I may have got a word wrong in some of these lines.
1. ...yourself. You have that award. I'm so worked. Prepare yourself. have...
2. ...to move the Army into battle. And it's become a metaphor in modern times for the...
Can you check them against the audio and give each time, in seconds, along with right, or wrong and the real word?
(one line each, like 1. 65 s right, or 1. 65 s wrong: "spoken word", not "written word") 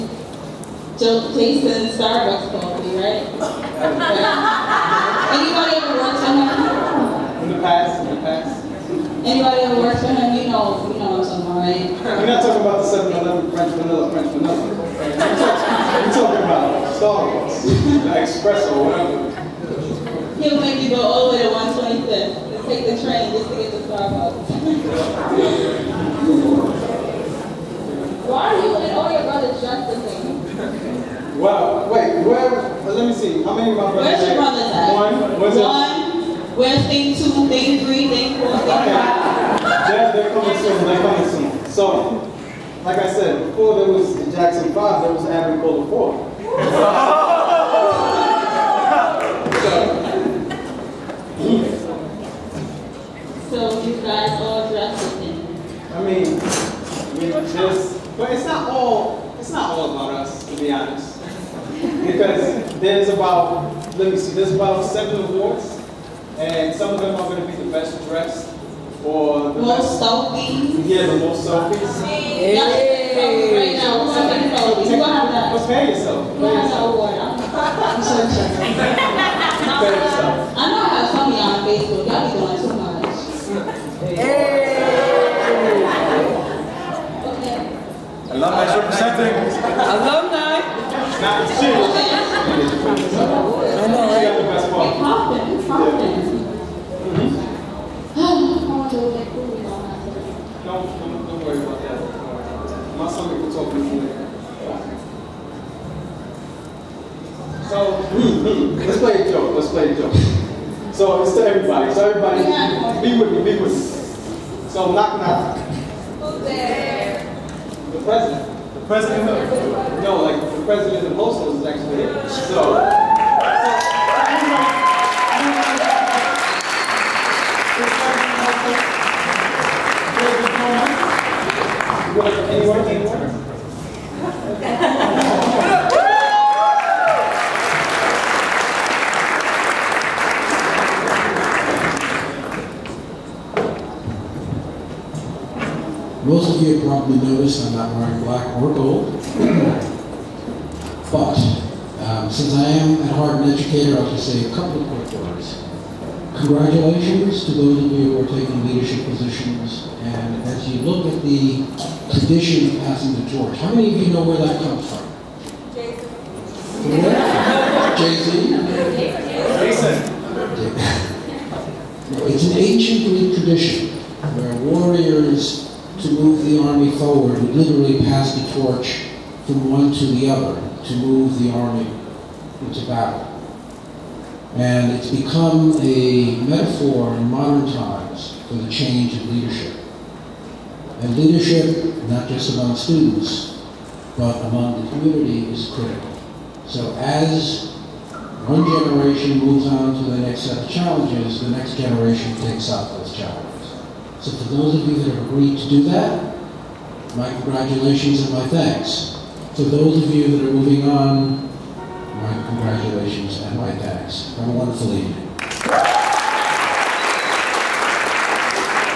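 1. 75 s wrong: "interested", not "worked"
2. 180 s right.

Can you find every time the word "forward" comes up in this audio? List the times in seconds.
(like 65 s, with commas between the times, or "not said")
176 s.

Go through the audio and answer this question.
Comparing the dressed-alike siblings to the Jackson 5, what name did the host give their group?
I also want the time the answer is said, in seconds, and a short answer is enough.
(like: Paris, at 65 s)
Agricola 4, at 45 s.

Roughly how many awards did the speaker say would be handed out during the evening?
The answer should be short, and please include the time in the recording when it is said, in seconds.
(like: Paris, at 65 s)
7, at 64 s.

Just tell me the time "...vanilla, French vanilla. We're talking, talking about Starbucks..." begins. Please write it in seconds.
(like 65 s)
13 s.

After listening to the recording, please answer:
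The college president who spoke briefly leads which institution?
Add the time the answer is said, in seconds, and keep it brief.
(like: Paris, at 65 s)
Hostos, at 121 s.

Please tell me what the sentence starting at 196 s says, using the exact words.
So as one generation moves on to the next set of challenges, the next generation takes up those challenges.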